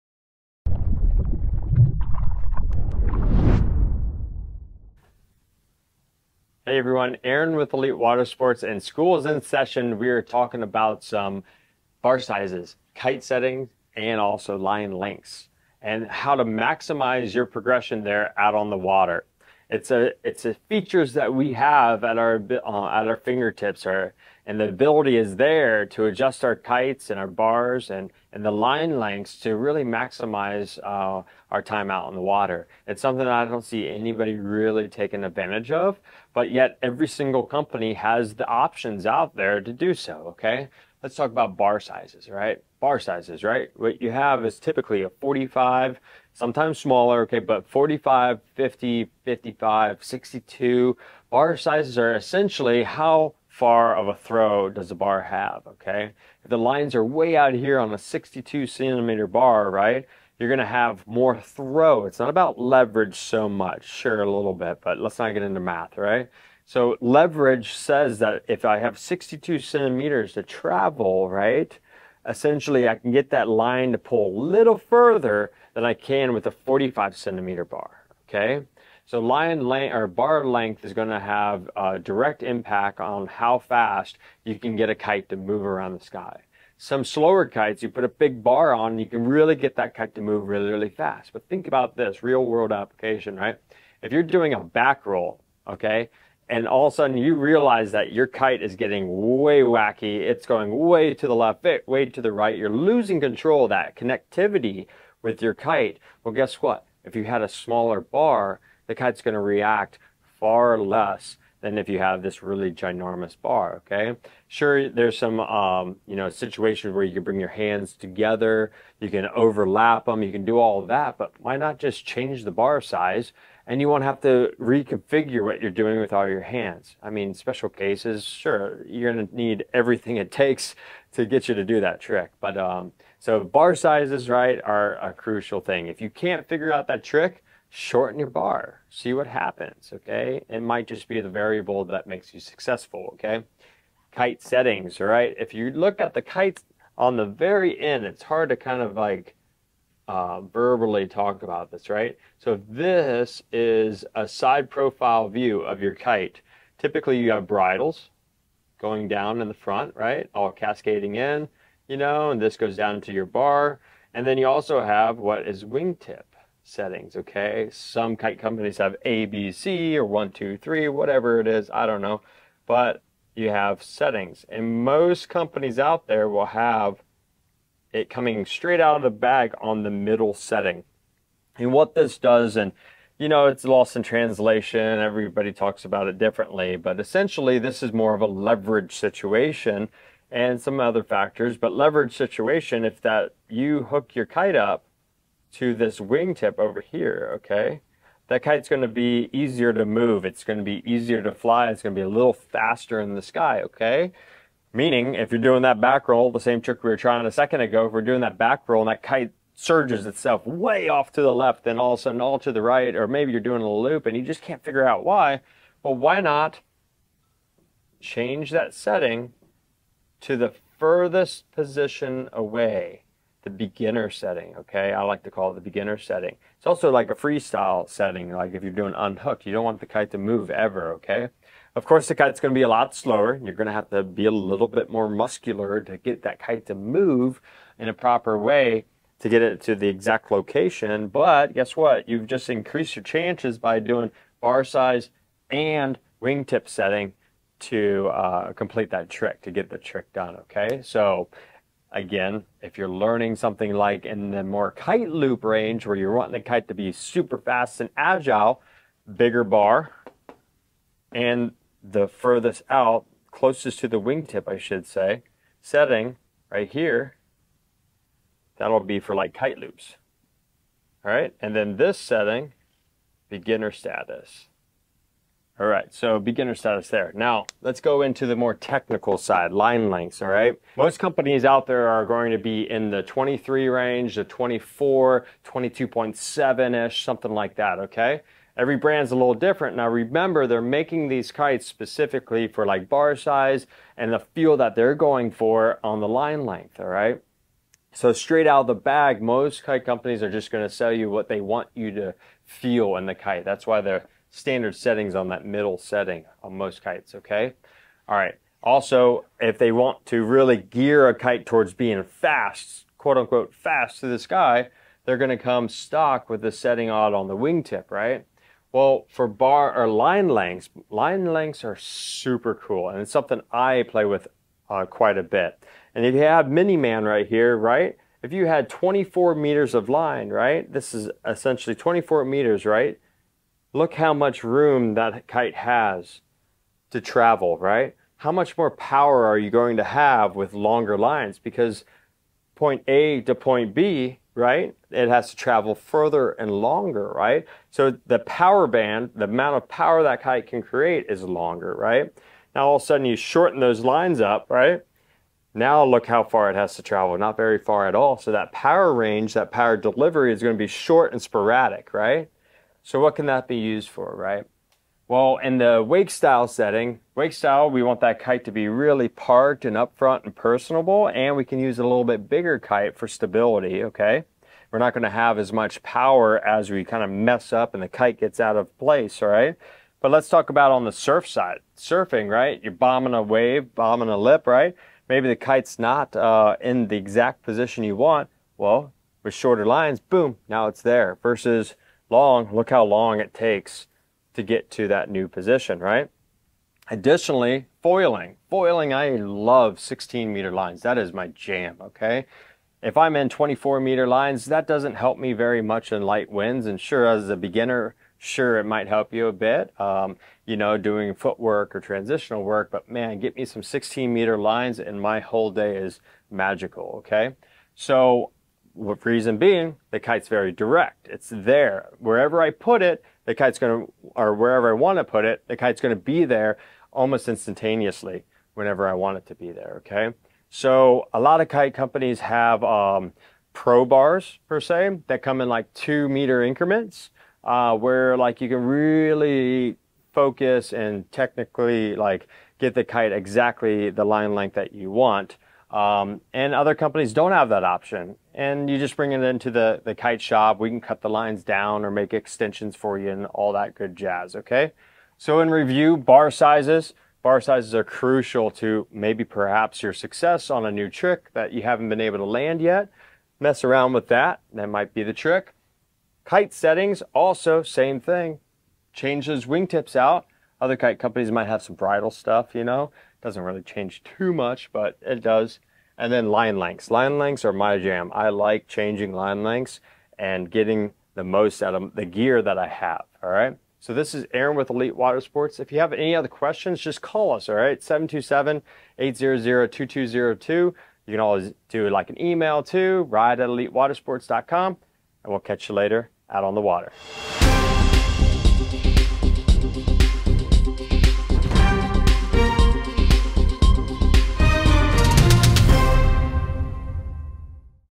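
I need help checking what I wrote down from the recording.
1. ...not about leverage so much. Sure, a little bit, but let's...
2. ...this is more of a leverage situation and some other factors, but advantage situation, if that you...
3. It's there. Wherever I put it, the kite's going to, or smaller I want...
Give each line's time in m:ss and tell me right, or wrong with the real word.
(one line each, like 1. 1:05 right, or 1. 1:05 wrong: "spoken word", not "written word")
1. 1:02 right
2. 3:07 wrong: "leverage", not "advantage"
3. 7:01 wrong: "wherever", not "smaller".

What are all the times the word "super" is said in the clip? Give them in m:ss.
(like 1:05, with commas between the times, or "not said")
4:16, 5:21.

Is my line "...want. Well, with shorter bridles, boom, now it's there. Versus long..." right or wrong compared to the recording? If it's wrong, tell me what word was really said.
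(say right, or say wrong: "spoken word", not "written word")
wrong: "lines", not "bridles".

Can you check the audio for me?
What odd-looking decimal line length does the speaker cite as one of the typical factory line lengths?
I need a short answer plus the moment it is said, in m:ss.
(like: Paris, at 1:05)
22.7 meters, at 4:45.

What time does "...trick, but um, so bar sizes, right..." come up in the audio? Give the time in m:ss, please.
2:12.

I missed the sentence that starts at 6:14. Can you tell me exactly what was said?
We're not gonna have as much power as we kind of mess up and the kite gets out of place, all right?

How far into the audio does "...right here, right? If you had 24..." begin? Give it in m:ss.
5:27.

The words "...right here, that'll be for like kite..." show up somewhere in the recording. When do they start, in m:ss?
4:26.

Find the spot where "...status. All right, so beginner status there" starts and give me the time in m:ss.
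4:33.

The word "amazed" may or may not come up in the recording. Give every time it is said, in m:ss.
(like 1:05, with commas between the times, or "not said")
not said.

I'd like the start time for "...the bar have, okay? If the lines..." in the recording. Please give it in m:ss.
0:54.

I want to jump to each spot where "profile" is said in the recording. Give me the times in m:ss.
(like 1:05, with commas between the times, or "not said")
2:34.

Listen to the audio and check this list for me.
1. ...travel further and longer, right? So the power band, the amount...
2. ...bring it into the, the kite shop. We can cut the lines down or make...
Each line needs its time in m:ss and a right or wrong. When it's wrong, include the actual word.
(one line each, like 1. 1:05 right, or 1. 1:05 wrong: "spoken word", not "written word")
1. 5:45 right
2. 7:28 right.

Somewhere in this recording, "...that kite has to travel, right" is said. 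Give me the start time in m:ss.
5:34.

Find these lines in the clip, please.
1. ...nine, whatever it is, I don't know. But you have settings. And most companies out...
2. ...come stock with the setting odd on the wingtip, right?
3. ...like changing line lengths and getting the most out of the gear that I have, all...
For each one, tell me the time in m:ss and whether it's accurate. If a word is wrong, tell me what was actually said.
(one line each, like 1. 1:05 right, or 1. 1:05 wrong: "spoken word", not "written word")
1. 2:50 wrong: "three", not "nine"
2. 5:15 right
3. 7:58 right.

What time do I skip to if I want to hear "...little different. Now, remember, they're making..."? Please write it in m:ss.
4:49.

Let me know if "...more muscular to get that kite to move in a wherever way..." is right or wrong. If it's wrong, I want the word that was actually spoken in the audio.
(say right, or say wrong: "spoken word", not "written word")
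wrong: "proper", not "wherever".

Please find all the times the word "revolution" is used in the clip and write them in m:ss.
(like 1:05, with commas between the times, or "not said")
not said.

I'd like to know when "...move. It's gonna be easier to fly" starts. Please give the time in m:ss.
3:19.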